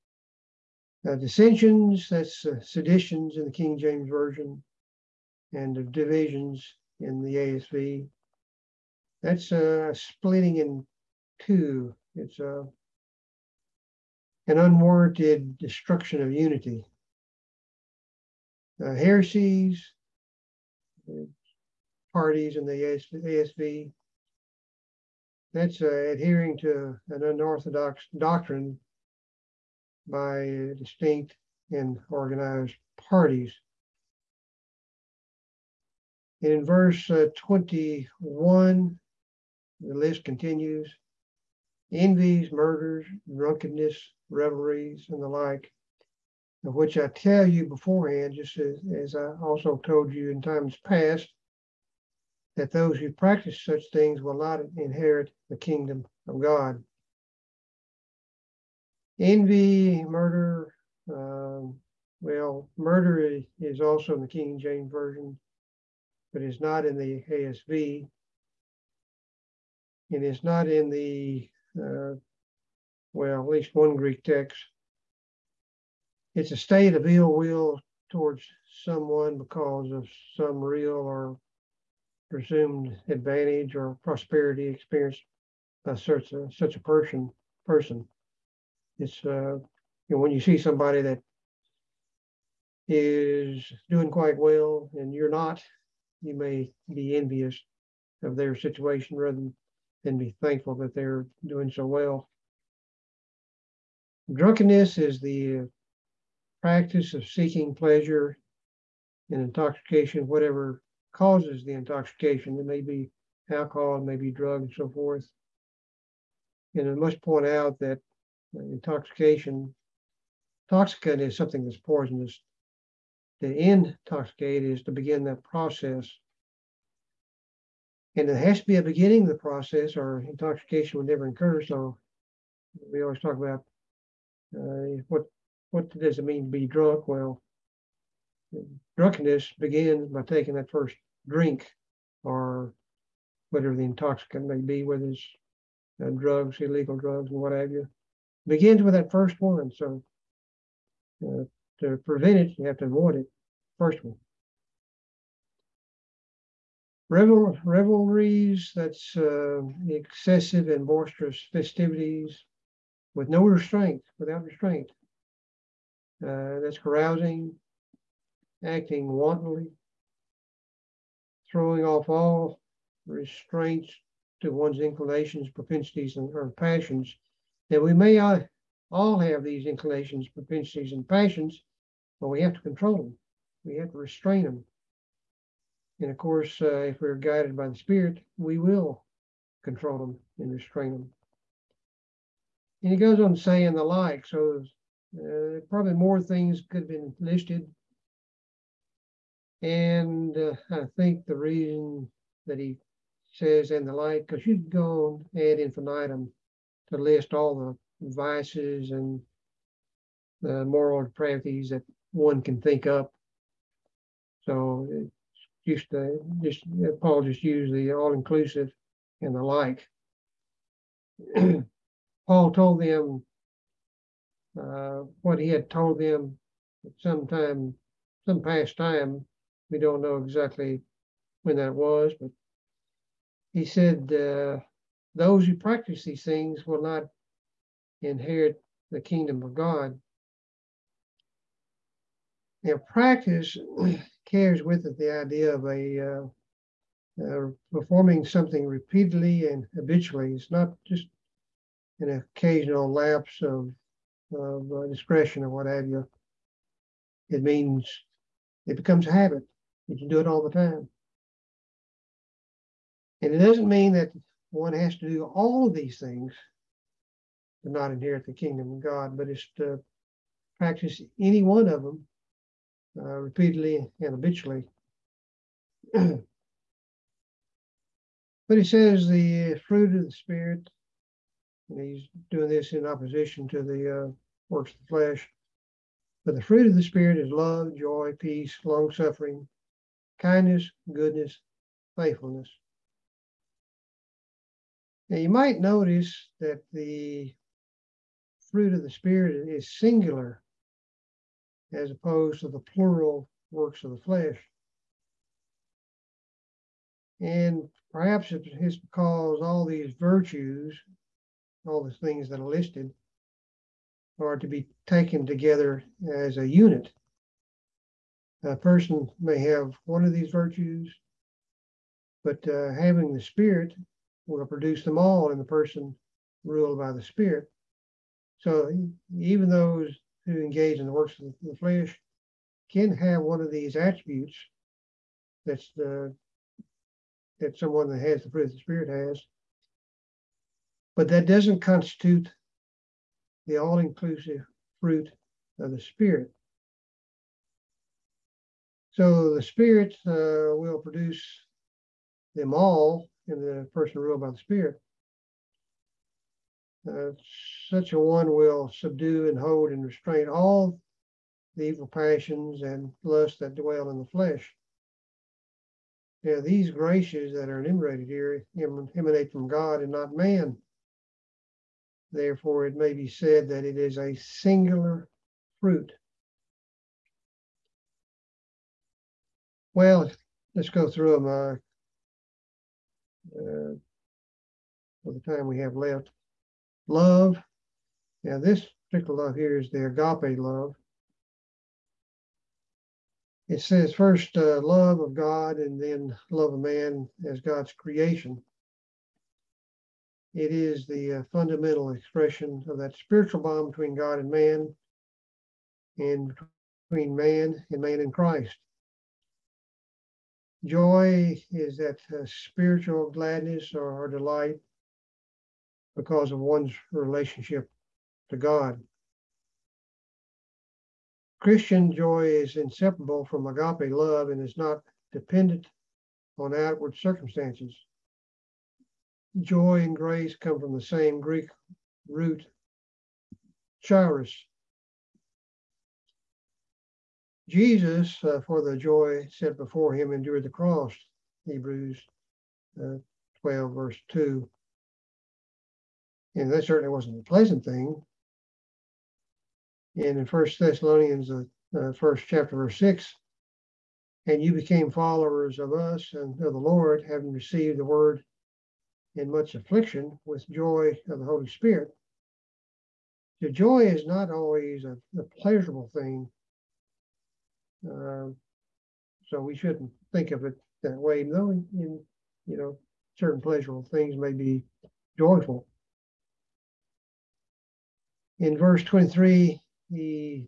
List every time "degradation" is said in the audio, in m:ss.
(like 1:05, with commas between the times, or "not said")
not said.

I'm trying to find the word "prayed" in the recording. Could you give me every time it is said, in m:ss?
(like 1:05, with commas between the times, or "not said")
not said.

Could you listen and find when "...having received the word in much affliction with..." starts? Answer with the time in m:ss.
7:37.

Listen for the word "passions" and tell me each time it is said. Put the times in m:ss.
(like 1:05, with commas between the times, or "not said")
2:56, 3:01, 6:01.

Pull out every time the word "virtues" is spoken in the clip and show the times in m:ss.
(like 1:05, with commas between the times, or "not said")
5:09, 5:20.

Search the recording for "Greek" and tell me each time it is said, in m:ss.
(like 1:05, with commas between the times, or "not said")
1:13, 7:11.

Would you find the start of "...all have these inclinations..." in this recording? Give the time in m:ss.
2:58.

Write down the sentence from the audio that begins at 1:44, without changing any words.
Drunkenness is the practice of seeking pleasure and intoxication, whatever causes the intoxication.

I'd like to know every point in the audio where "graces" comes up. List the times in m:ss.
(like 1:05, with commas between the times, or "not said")
6:06, 7:09.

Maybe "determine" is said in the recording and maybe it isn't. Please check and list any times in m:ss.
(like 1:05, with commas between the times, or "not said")
not said.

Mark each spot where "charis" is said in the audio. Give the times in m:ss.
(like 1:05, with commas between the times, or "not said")
7:13.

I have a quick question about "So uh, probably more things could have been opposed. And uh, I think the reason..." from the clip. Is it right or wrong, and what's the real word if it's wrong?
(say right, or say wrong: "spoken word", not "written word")
wrong: "listed", not "opposed".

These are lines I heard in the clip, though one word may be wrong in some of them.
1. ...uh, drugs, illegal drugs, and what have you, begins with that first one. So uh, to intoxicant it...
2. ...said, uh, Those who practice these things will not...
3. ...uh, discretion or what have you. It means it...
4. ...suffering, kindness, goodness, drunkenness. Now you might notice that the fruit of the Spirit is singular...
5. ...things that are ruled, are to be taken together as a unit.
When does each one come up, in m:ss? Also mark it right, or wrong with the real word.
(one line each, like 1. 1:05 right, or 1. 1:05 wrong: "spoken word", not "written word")
1. 2:26 wrong: "prevent", not "intoxicant"
2. 3:53 right
3. 4:14 right
4. 4:48 wrong: "faithfulness", not "drunkenness"
5. 5:11 wrong: "listed", not "ruled".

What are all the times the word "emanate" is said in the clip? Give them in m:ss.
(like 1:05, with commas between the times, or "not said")
6:08.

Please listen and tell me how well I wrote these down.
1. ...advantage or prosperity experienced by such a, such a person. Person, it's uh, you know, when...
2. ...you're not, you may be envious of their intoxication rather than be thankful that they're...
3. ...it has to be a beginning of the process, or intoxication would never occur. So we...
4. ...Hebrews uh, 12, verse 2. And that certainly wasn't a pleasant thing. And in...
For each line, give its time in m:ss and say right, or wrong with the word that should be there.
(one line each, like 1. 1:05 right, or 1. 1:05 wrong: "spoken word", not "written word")
1. 1:23 right
2. 1:35 wrong: "situation", not "intoxication"
3. 2:08 right
4. 7:21 right.